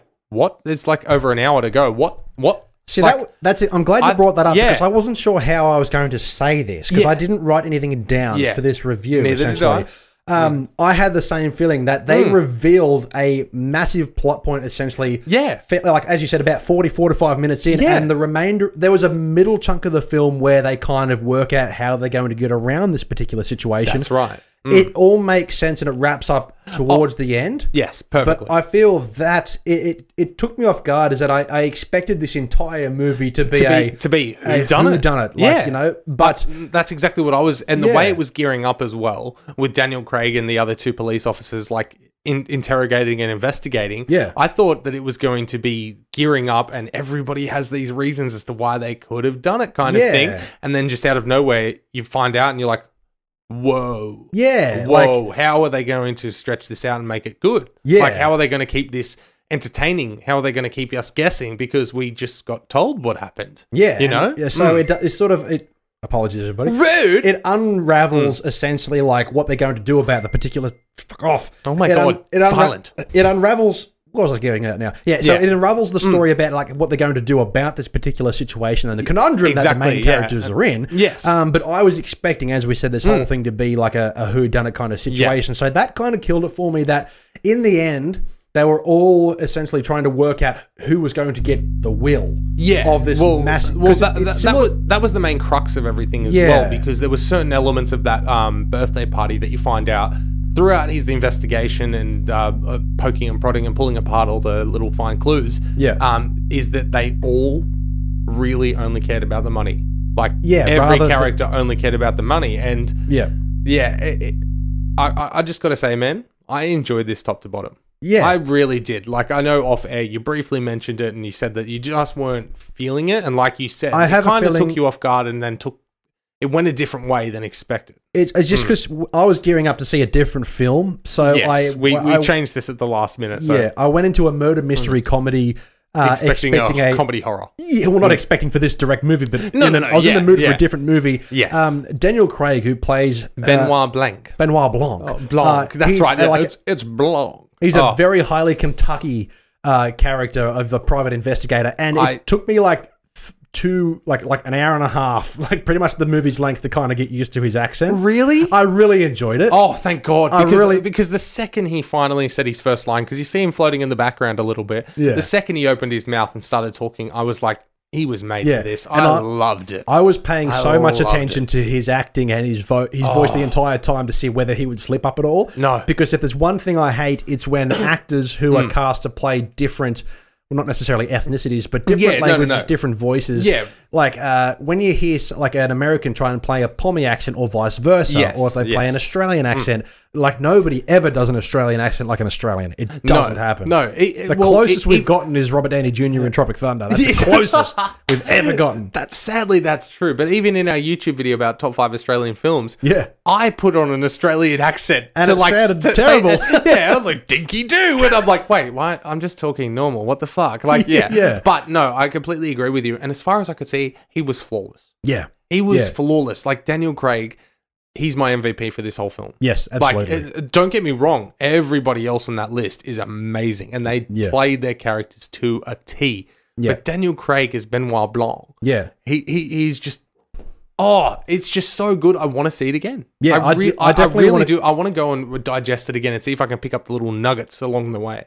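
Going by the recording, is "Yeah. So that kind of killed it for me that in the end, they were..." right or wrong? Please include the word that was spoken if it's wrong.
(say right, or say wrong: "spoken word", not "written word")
right.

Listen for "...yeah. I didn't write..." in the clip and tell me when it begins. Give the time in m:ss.
0:07.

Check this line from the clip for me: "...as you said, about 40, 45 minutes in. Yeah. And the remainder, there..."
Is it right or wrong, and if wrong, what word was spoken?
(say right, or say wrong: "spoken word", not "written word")
right.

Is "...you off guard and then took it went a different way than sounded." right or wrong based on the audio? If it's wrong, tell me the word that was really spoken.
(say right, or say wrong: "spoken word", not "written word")
wrong: "expected", not "sounded".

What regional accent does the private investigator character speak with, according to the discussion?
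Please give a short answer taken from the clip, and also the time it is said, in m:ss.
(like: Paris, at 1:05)
Kentucky, at 2:28.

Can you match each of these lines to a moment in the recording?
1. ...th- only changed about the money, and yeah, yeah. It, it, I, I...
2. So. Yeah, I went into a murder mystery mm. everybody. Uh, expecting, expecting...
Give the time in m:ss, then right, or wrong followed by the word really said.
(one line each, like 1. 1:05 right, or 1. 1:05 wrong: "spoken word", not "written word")
1. 1:51 wrong: "cared", not "changed"
2. 2:13 wrong: "comedy", not "everybody".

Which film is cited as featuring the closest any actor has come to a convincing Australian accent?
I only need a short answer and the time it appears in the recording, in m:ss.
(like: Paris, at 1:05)
Tropic Thunder, at 3:16.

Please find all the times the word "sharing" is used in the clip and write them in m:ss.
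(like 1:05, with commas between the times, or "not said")
not said.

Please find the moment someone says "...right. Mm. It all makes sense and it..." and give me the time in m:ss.
0:24.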